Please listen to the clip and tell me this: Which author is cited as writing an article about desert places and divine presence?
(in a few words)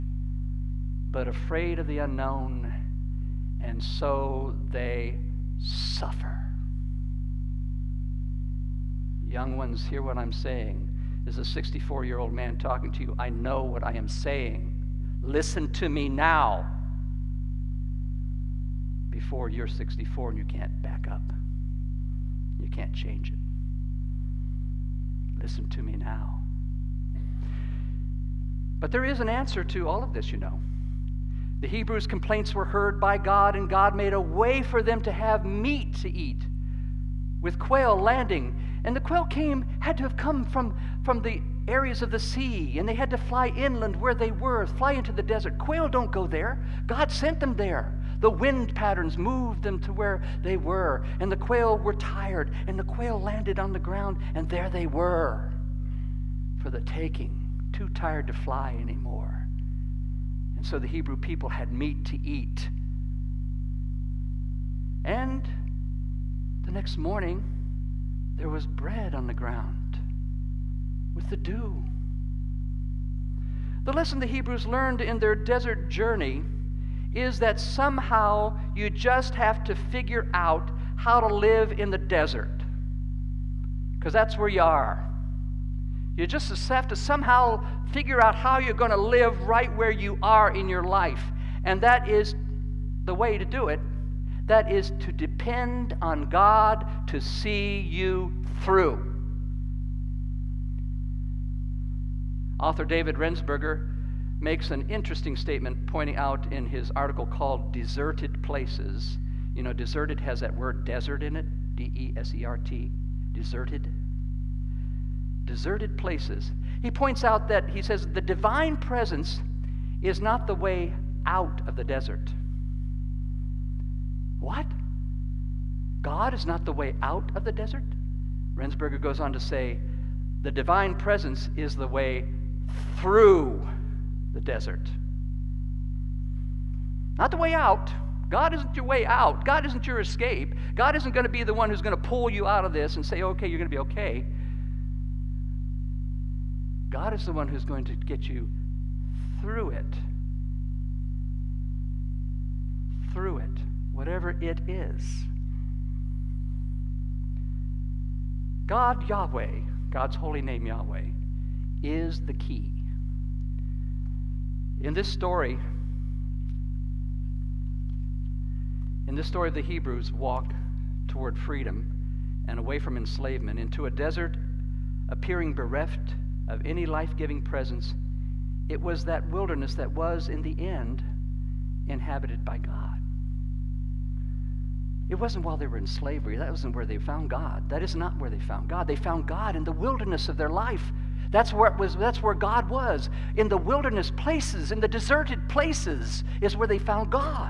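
David Rensberger.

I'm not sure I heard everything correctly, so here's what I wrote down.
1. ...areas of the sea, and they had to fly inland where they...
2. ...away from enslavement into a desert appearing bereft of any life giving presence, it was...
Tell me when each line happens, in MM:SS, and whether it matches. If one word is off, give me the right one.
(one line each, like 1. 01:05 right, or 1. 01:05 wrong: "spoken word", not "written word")
1. 00:41 right
2. 02:52 right.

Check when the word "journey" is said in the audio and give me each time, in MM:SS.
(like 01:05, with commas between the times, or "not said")
01:15.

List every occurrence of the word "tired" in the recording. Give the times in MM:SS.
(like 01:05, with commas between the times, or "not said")
00:51, 00:57.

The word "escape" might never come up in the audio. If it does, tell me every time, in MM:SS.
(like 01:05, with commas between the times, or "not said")
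02:19.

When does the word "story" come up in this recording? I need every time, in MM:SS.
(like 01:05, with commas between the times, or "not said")
02:45, 02:49.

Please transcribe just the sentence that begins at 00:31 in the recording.
The Hebrews' complaints were heard by God, and God made a way for them to have meat to eat with quail landing.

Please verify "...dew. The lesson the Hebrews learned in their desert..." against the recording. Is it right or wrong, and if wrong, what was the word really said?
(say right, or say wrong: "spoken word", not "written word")
right.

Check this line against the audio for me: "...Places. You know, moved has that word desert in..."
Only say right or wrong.
wrong.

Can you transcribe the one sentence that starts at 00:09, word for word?
Young ones, hear what I'm saying.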